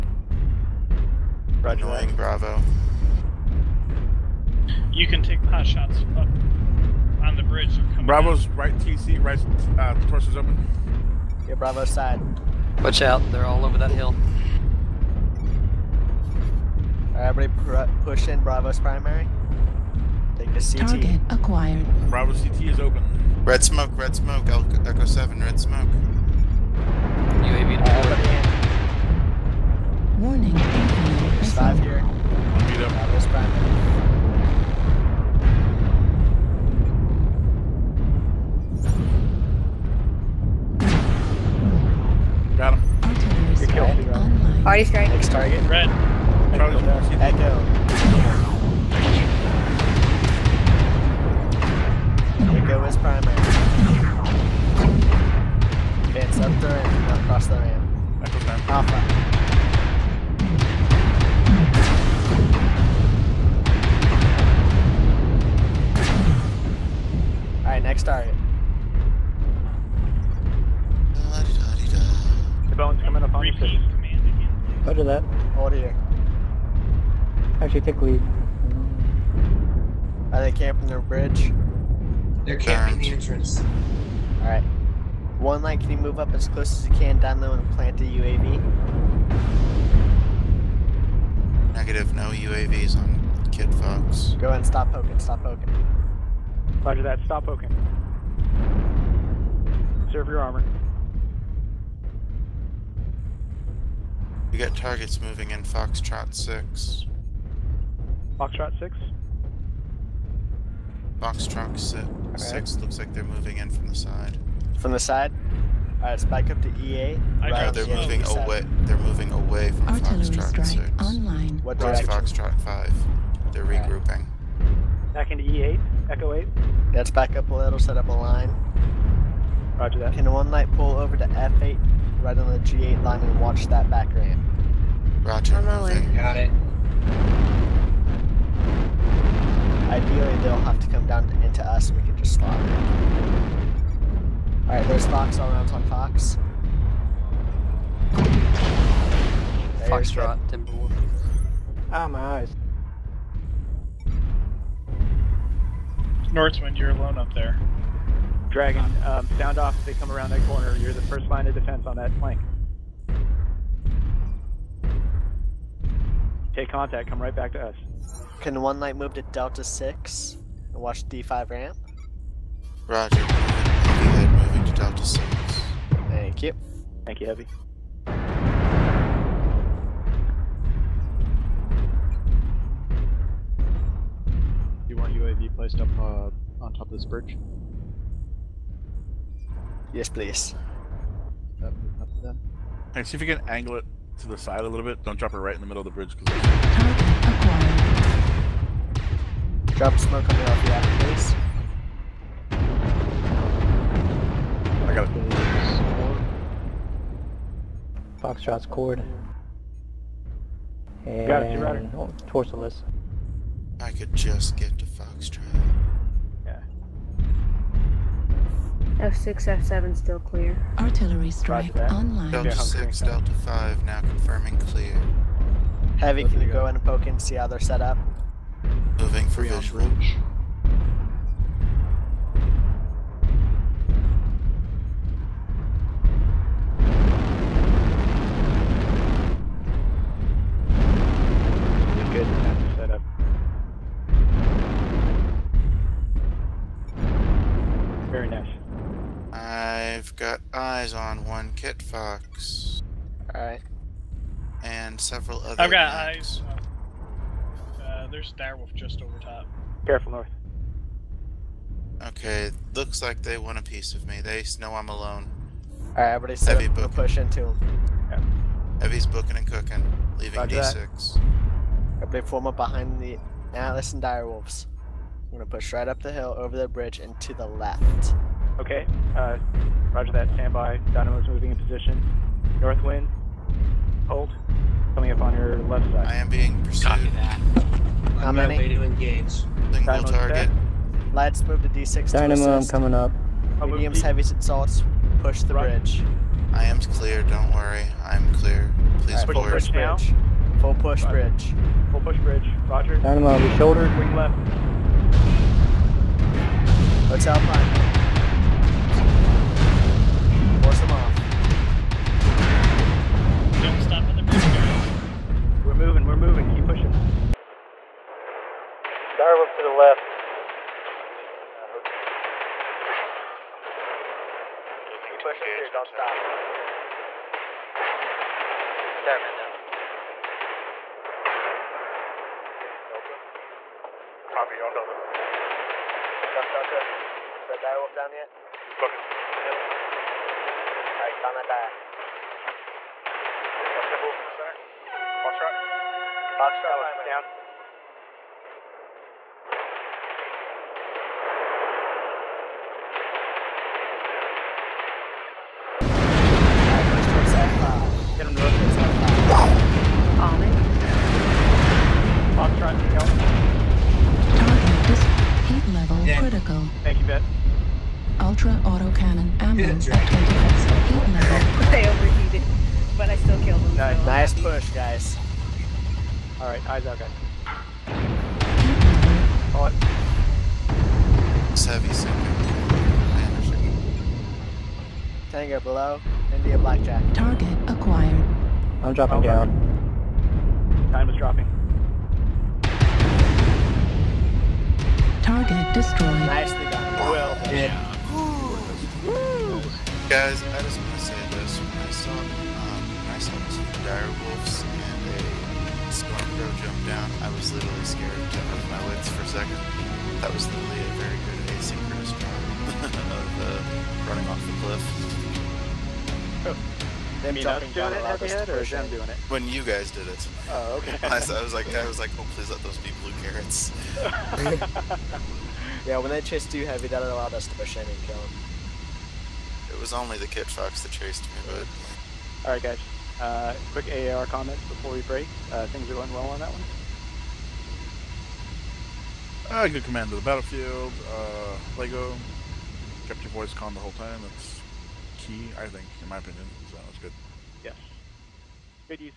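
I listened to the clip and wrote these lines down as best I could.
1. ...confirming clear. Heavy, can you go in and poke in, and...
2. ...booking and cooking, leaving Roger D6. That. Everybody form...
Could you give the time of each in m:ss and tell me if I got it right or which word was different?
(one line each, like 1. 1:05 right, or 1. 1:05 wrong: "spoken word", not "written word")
1. 3:44 right
2. 4:29 right.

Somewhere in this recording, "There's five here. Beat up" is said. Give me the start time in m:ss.
0:31.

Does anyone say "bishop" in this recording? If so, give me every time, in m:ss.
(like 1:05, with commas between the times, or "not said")
not said.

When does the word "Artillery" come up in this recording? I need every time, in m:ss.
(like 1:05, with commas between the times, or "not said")
0:43, 3:40.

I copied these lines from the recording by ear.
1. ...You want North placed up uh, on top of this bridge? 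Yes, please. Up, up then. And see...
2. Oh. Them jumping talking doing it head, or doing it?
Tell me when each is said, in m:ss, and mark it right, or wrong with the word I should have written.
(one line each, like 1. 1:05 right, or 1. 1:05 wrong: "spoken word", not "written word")
1. 3:04 wrong: "UAV", not "North"
2. 6:56 right.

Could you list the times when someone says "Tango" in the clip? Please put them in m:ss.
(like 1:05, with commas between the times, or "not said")
6:25.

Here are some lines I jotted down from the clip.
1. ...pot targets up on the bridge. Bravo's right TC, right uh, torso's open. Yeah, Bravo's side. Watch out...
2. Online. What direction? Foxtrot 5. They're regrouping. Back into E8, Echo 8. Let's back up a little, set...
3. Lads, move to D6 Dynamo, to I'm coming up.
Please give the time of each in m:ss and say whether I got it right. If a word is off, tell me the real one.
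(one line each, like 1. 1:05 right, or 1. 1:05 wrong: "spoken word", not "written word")
1. 0:05 wrong: "shots", not "targets"
2. 2:00 right
3. 4:51 right.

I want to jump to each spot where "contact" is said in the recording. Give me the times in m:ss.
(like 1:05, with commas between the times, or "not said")
2:46.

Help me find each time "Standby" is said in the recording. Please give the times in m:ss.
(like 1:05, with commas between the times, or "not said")
4:40.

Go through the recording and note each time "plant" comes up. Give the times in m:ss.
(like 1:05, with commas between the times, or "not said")
1:27.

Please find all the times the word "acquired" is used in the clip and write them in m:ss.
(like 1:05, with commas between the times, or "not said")
0:21, 6:27.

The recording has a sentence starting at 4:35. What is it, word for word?
I'm gonna push right up the hill, over the bridge, and to the left.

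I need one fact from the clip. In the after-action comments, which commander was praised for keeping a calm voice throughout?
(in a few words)
Lego.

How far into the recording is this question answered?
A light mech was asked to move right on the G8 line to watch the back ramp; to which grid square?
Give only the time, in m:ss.
2:11.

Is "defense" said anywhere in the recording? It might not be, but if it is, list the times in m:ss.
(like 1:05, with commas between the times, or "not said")
2:41.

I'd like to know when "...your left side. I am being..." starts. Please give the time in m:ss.
4:45.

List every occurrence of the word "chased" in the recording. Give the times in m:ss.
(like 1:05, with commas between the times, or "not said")
7:06, 7:10.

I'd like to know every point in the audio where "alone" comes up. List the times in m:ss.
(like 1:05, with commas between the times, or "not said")
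2:36, 4:24.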